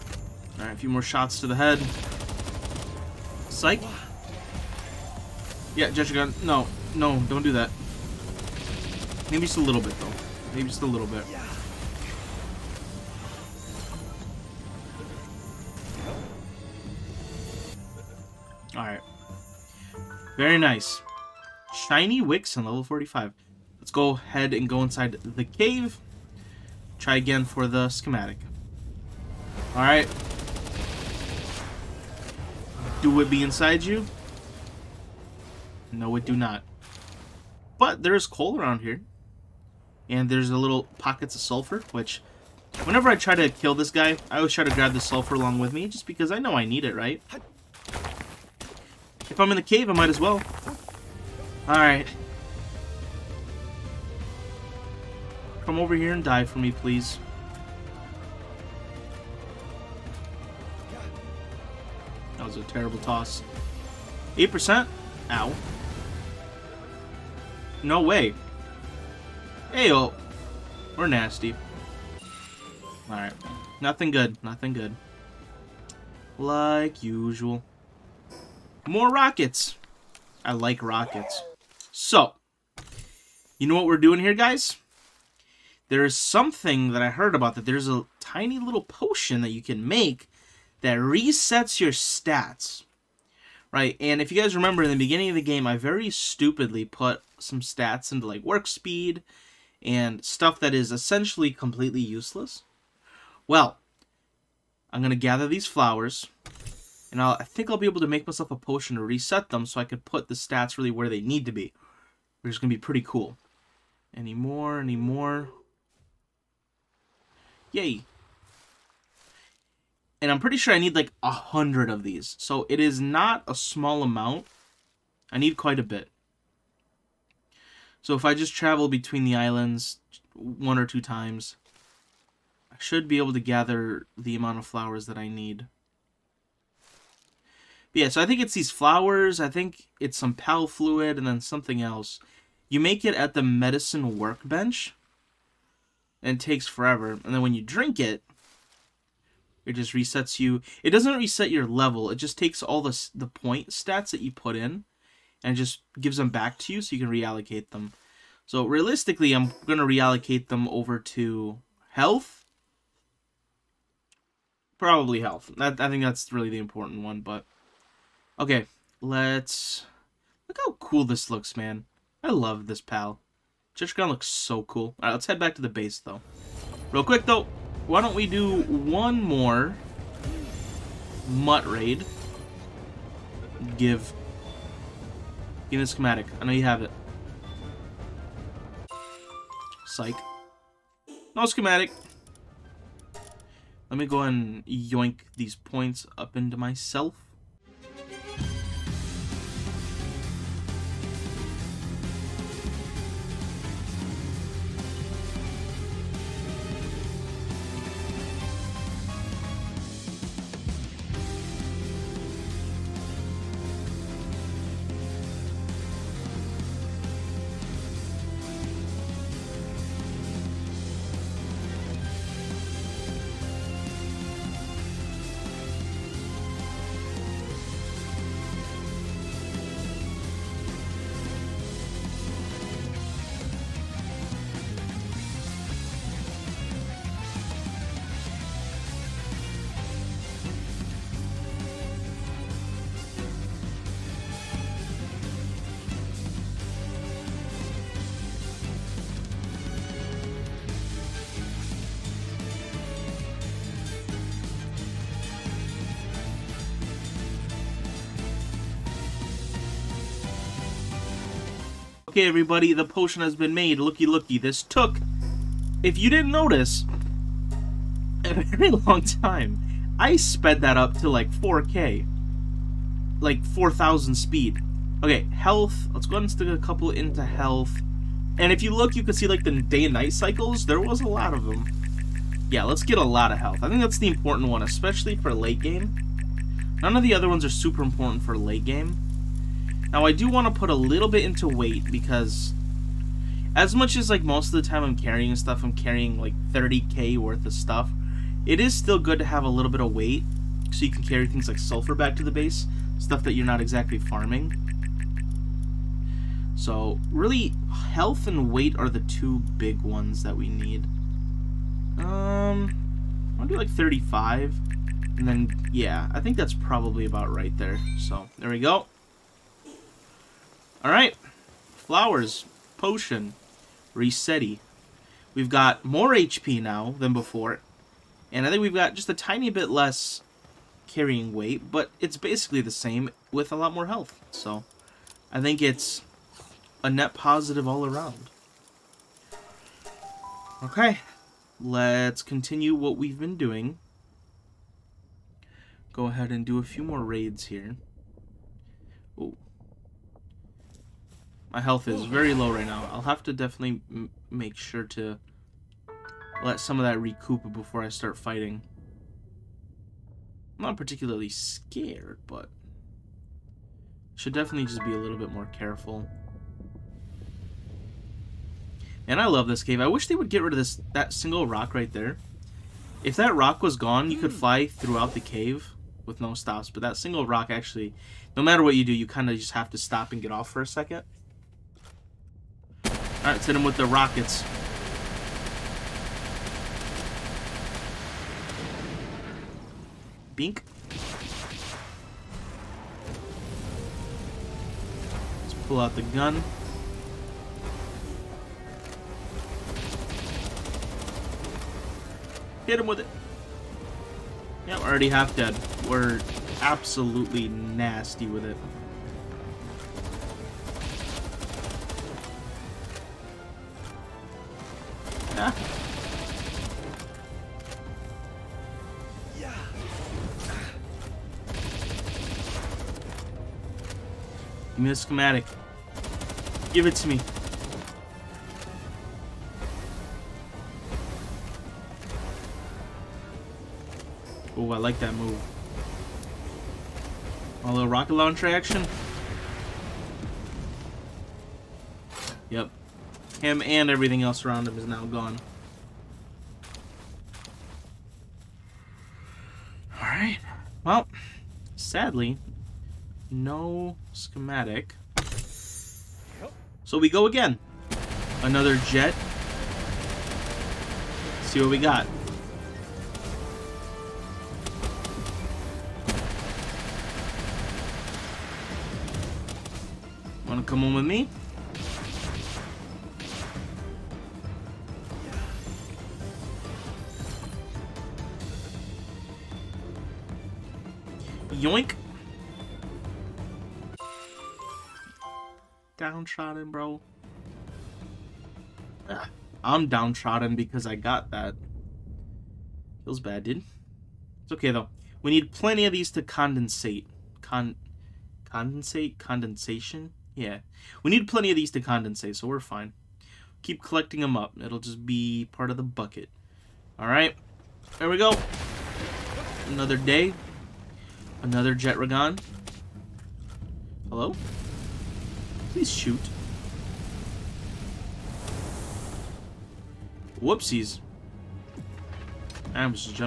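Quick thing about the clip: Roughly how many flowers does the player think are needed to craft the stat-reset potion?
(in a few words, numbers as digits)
100.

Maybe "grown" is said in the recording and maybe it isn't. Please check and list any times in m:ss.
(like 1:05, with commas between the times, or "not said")
not said.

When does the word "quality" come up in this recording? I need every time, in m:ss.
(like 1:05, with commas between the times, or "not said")
not said.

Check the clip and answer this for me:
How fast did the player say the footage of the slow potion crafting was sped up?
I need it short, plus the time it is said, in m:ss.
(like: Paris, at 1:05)
4,000 speed, at 4:33.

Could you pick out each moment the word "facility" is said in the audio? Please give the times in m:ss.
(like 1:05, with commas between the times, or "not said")
not said.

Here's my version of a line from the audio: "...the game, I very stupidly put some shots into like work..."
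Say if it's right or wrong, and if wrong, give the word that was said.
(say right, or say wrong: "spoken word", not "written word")
wrong: "stats", not "shots".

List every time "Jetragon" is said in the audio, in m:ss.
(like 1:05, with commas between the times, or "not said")
0:05, 2:53, 8:31.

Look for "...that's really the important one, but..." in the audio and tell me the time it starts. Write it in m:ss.
2:46.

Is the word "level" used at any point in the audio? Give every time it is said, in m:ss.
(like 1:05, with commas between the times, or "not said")
0:22, 2:31.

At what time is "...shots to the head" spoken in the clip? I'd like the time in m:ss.
0:01.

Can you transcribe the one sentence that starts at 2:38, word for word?
So realistically, I'm going to reallocate them over to health.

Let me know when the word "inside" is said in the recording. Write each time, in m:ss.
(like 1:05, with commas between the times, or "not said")
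0:24, 0:33.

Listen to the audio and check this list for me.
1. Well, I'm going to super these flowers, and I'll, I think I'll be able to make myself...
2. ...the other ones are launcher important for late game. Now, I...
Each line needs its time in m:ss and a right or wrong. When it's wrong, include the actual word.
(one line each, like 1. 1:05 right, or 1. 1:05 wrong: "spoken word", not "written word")
1. 1:43 wrong: "gather", not "super"
2. 4:47 wrong: "super", not "launcher".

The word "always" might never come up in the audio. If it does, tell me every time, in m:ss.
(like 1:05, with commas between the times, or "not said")
0:44.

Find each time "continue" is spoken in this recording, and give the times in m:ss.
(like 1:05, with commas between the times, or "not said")
5:42.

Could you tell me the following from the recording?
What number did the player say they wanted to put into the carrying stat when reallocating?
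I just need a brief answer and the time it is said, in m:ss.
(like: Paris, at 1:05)
35, at 5:13.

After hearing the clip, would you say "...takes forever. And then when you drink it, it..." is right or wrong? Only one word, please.
right.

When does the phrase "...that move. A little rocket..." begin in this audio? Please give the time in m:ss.
7:14.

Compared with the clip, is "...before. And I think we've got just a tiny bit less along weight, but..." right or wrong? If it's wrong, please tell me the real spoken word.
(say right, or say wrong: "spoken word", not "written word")
wrong: "carrying", not "along".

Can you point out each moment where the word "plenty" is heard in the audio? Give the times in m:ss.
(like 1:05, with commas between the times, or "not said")
8:15, 8:21.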